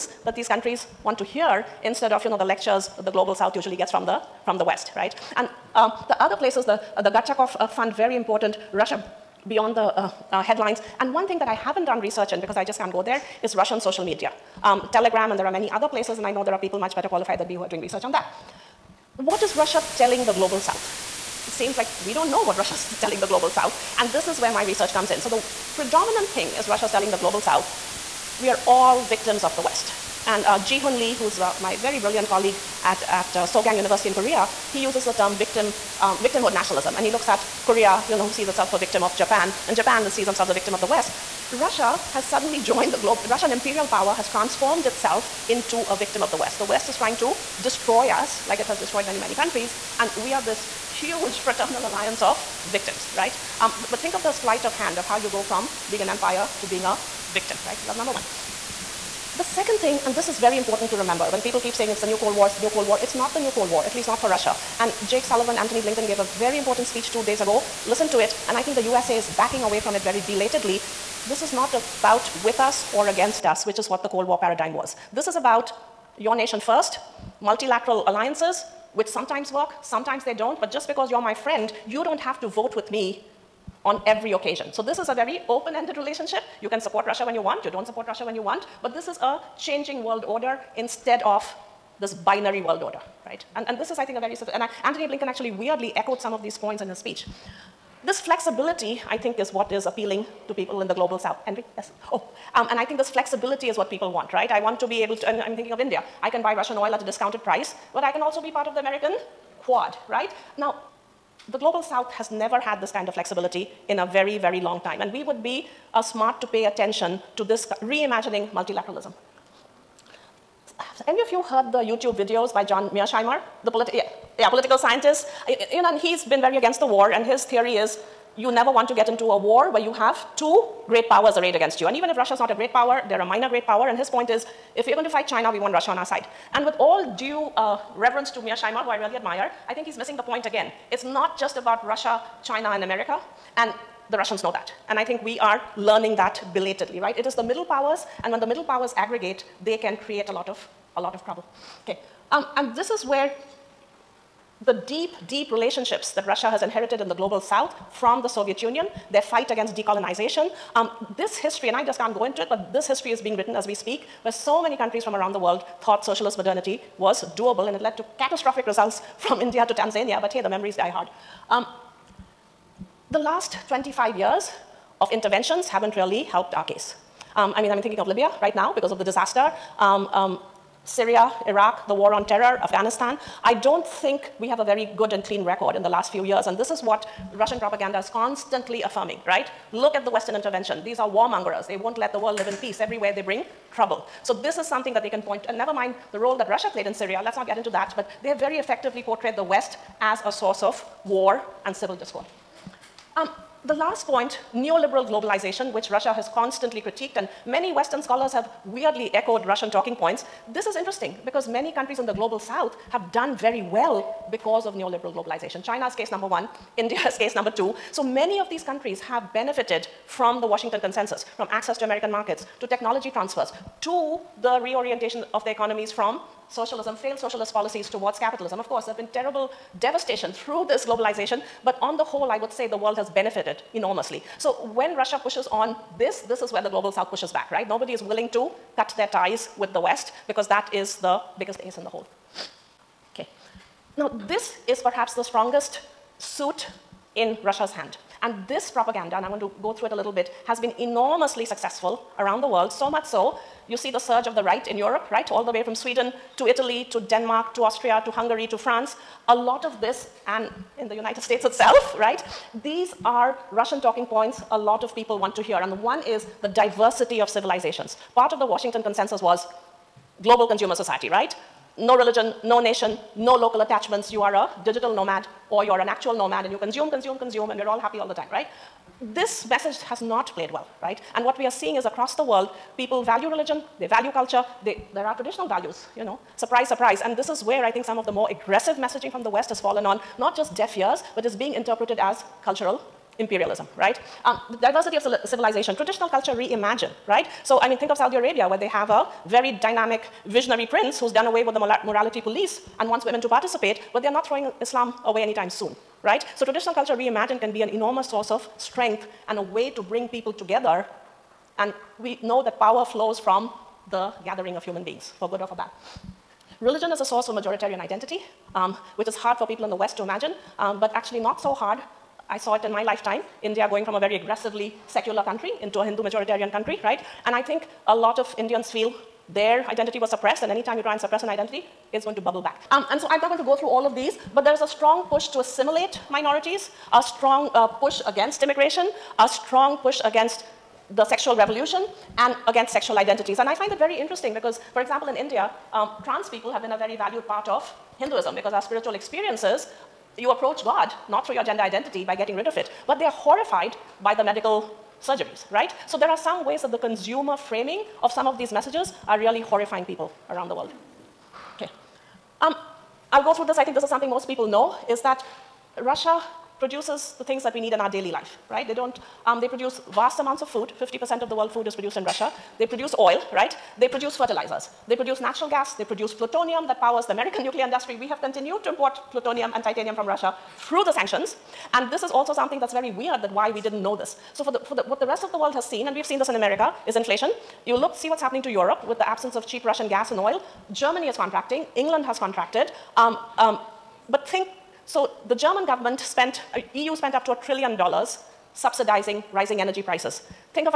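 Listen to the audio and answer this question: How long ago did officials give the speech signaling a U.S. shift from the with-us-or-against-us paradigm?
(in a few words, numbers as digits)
2 days ago.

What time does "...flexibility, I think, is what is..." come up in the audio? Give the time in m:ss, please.
1:38.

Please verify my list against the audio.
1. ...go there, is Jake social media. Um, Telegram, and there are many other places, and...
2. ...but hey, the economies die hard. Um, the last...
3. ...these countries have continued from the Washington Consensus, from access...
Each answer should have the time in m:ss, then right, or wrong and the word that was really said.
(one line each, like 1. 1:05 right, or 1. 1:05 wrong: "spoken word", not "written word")
1. 0:12 wrong: "Russian", not "Jake"
2. 2:50 wrong: "memories", not "economies"
3. 3:38 wrong: "benefited", not "continued".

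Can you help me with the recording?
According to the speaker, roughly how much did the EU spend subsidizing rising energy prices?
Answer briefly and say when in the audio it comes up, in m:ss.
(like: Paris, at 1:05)
a trillion dollars, at 6:37.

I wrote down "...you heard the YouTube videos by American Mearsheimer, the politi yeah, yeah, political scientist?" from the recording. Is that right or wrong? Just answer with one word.
wrong.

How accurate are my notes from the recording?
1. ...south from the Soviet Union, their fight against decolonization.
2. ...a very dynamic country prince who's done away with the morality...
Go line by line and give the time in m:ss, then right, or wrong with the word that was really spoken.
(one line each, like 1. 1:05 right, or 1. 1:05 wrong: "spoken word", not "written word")
1. 2:37 right
2. 4:58 wrong: "visionary", not "country".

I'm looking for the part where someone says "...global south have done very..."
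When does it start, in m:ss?
3:32.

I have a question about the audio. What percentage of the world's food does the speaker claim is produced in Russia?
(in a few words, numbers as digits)
50%.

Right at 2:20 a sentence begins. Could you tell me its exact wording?
It's not just about Russia, China, and America, and the Russians know that.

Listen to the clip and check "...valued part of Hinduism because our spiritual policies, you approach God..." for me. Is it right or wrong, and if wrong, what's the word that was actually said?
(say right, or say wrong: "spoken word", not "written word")
wrong: "experiences", not "policies".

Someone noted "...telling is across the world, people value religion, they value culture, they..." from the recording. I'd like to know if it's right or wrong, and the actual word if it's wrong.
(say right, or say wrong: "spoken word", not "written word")
wrong: "seeing", not "telling".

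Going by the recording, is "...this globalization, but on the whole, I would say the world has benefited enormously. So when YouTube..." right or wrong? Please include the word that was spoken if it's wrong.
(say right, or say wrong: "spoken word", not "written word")
wrong: "Russia", not "YouTube".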